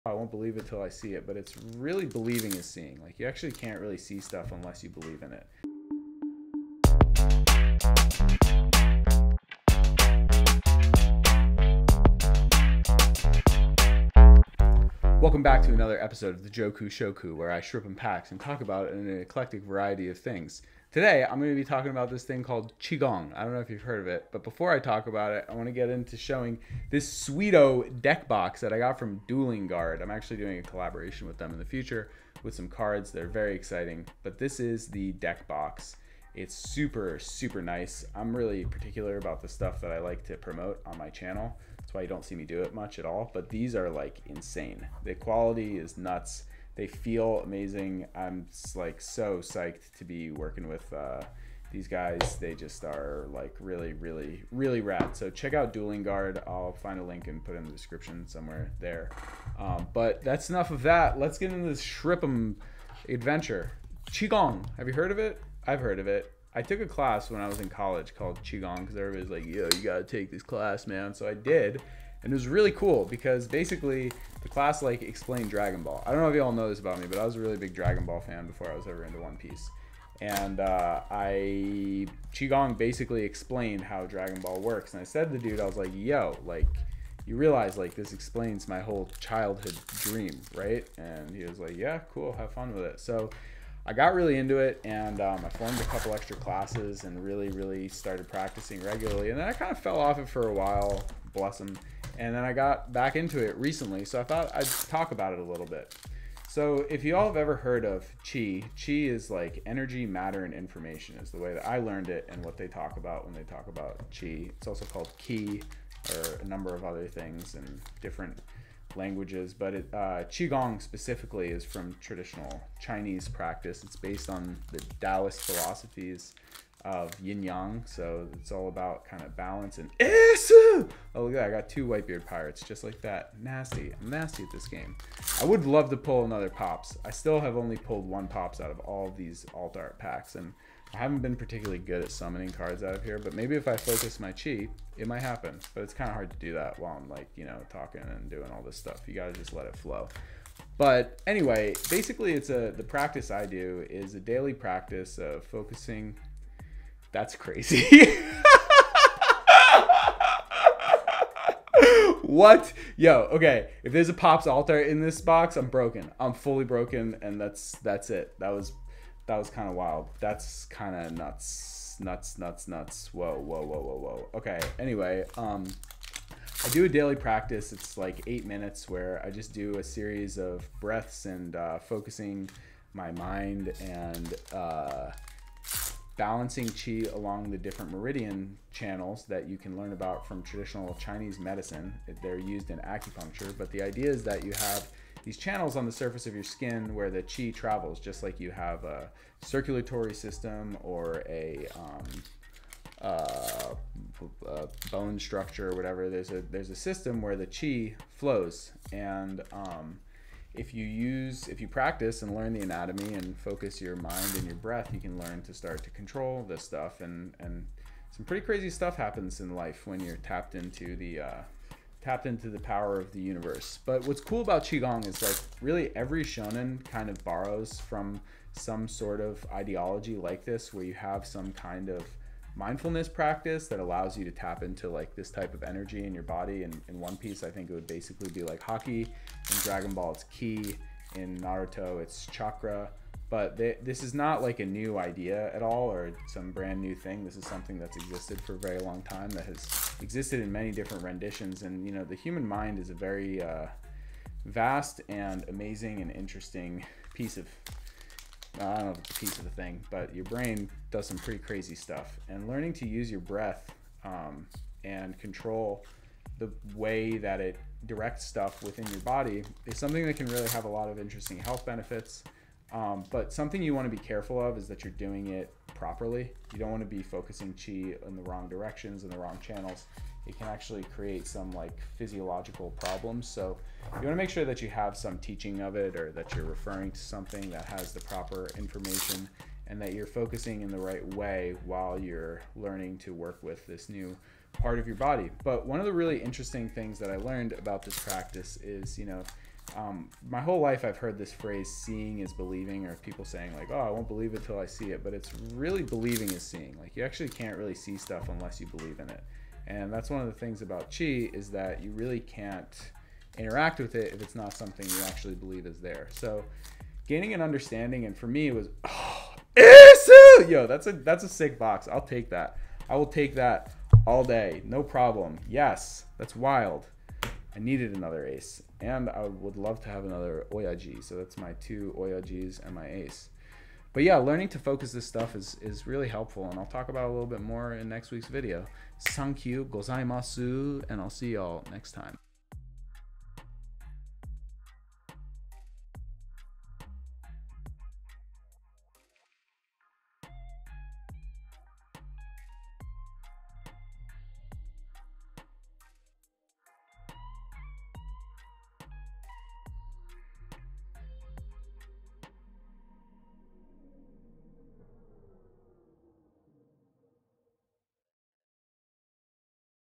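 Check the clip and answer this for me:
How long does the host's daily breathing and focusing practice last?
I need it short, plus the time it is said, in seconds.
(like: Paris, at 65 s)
8 minutes, at 178 s.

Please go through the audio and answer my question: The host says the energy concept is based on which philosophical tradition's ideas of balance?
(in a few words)
Taoist.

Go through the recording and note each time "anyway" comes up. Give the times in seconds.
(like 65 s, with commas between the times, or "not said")
151 s, 174 s.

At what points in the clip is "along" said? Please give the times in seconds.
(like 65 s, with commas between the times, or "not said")
187 s.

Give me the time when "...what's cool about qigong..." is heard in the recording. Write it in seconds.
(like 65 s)
224 s.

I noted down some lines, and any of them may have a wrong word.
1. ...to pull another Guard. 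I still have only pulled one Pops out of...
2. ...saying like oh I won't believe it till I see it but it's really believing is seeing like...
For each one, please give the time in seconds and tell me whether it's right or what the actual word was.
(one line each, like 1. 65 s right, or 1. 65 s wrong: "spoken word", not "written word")
1. 135 s wrong: "Pops", not "Guard"
2. 303 s right.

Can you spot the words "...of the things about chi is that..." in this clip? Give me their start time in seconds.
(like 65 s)
310 s.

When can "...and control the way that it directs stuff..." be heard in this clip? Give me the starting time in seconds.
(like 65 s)
264 s.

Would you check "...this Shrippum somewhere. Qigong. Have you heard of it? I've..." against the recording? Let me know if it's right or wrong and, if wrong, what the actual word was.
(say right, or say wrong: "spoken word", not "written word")
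wrong: "adventure", not "somewhere".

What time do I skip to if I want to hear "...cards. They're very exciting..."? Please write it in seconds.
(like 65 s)
32 s.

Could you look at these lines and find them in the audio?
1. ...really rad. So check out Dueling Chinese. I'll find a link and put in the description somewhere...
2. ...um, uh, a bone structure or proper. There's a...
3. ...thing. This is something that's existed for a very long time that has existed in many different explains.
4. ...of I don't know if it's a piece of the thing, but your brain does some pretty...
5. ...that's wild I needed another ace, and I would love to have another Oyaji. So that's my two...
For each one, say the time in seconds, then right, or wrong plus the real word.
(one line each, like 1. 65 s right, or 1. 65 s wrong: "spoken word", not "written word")
1. 54 s wrong: "Guard", not "Chinese"
2. 201 s wrong: "whatever", not "proper"
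3. 246 s wrong: "renditions", not "explains"
4. 257 s right
5. 326 s right.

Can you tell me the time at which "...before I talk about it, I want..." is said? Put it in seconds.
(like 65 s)
24 s.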